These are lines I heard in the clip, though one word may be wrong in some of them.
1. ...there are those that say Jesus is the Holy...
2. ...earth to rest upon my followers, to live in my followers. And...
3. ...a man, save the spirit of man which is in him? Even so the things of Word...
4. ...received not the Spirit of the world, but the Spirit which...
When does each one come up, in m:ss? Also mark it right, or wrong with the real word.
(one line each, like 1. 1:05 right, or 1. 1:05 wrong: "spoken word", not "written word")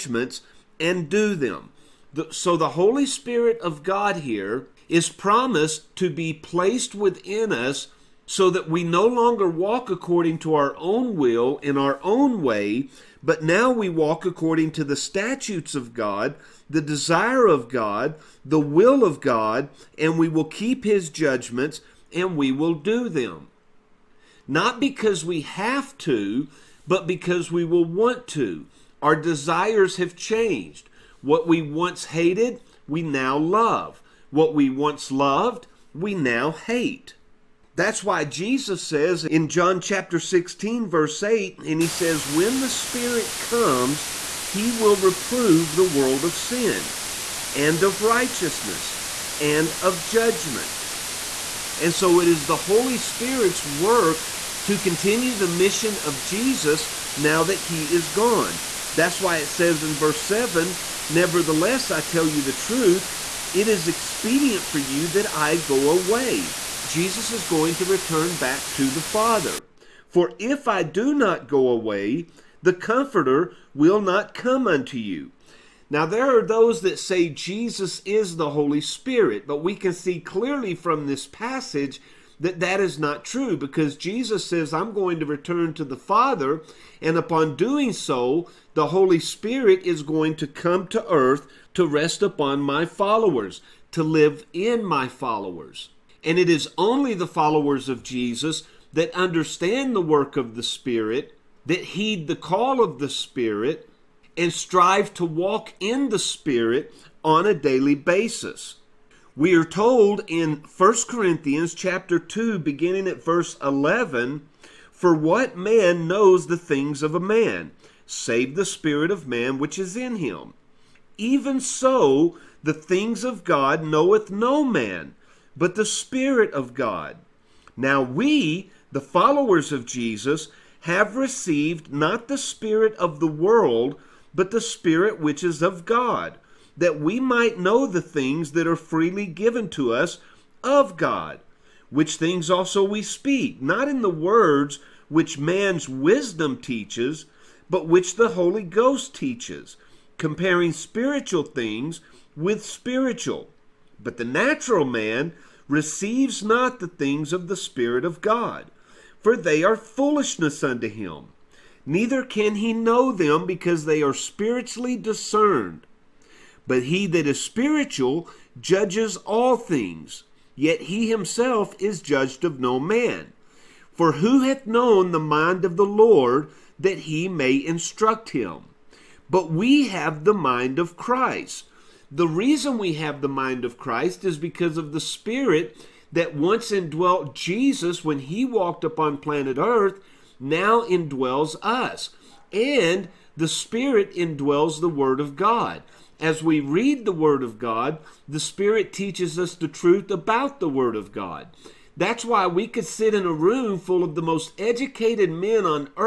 1. 1:16 right
2. 1:31 right
3. 1:57 wrong: "God", not "Word"
4. 2:11 right.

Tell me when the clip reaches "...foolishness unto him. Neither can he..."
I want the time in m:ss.
2:39.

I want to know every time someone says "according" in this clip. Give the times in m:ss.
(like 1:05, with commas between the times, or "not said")
0:09, 0:14.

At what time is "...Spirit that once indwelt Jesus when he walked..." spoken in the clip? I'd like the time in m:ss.
3:04.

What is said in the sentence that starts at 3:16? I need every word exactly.
As we read the Word of God, the Spirit teaches us the truth about the Word of God.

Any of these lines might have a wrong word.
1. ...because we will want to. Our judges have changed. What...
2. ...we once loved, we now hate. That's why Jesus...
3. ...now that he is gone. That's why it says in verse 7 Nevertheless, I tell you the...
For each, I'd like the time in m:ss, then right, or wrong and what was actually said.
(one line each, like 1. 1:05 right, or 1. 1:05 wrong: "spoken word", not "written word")
1. 0:27 wrong: "desires", not "judges"
2. 0:34 right
3. 0:57 right.